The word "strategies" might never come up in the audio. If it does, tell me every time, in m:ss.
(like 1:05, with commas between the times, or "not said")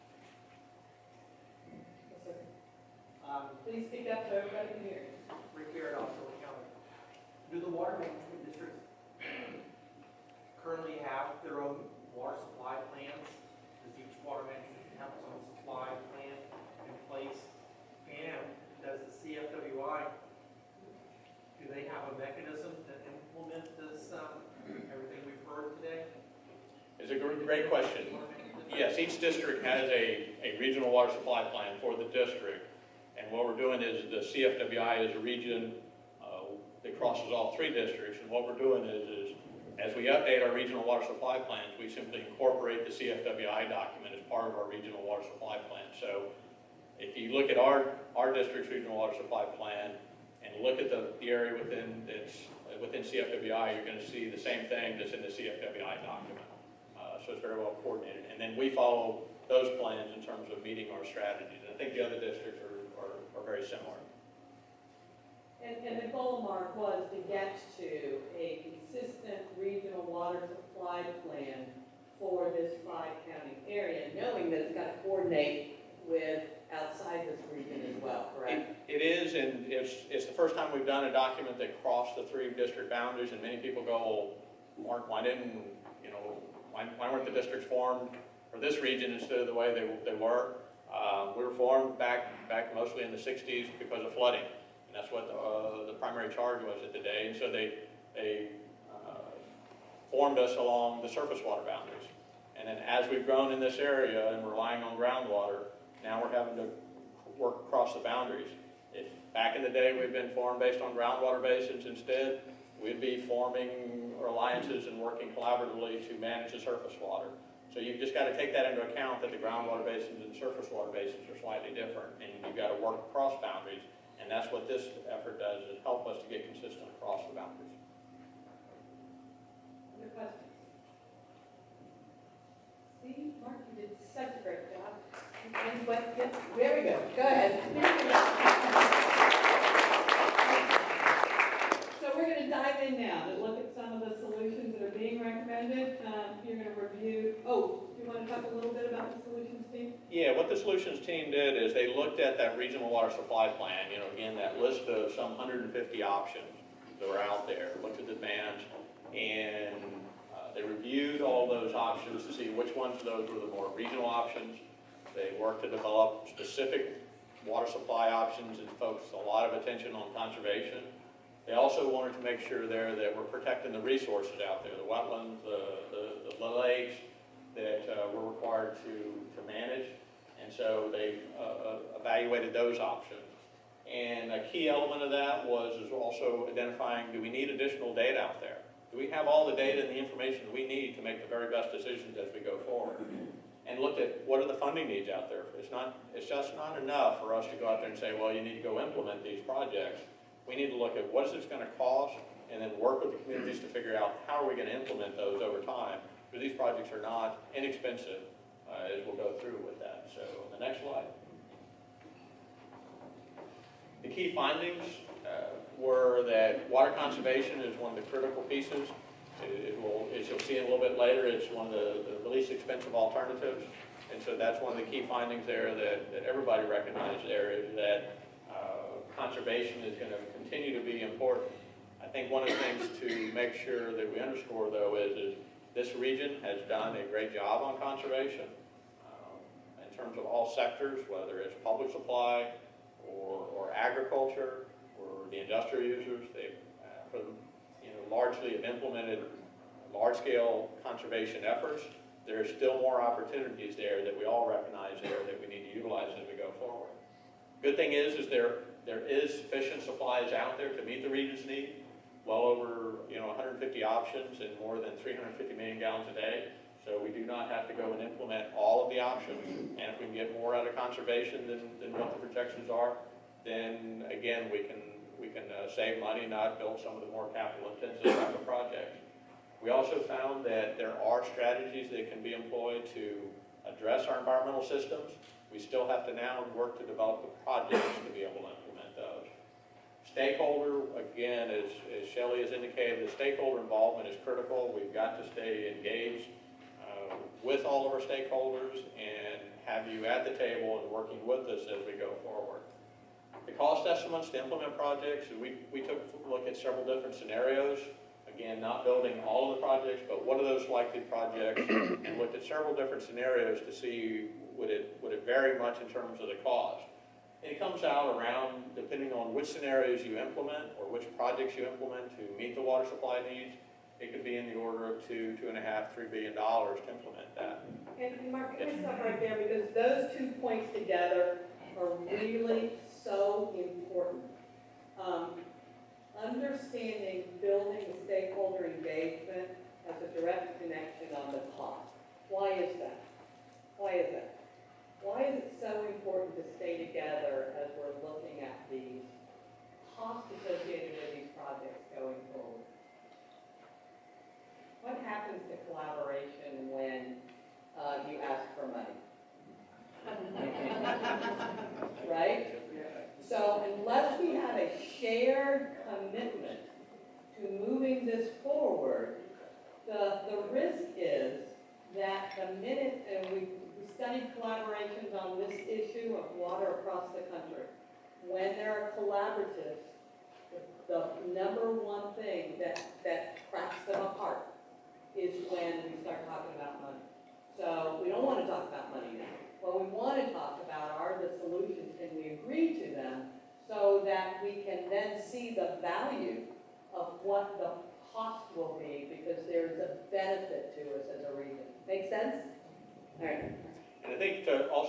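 1:01, 4:41.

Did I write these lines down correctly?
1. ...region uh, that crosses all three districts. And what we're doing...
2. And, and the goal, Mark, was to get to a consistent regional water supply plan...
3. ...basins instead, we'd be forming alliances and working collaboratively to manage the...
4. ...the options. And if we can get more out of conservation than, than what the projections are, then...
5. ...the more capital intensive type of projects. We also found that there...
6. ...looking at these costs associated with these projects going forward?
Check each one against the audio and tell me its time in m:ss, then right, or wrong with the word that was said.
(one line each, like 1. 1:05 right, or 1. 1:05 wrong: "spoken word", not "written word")
1. 0:35 right
2. 1:05 right
3. 1:51 right
4. 4:28 right
5. 4:37 right
6. 5:48 right.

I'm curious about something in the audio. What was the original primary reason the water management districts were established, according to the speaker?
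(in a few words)
Flooding.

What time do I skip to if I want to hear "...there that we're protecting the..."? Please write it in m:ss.
2:52.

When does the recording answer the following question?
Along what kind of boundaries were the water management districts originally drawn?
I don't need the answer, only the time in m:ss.
1:41.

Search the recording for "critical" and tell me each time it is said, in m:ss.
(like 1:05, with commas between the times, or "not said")
3:38, 4:54.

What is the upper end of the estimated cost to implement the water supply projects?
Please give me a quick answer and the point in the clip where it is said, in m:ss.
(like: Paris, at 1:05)
3 billion dollars, at 5:25.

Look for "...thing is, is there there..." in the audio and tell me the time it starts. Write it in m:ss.
4:17.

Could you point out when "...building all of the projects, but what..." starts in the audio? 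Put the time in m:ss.
5:08.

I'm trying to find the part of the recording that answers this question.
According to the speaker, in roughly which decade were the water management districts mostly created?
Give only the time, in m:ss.
1:33.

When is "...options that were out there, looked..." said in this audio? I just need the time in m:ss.
2:36.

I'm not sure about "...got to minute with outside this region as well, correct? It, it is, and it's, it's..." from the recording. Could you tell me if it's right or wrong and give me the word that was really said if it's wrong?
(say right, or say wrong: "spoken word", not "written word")
wrong: "coordinate", not "minute".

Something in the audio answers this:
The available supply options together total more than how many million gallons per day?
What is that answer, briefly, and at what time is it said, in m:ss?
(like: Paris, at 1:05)
350, at 4:25.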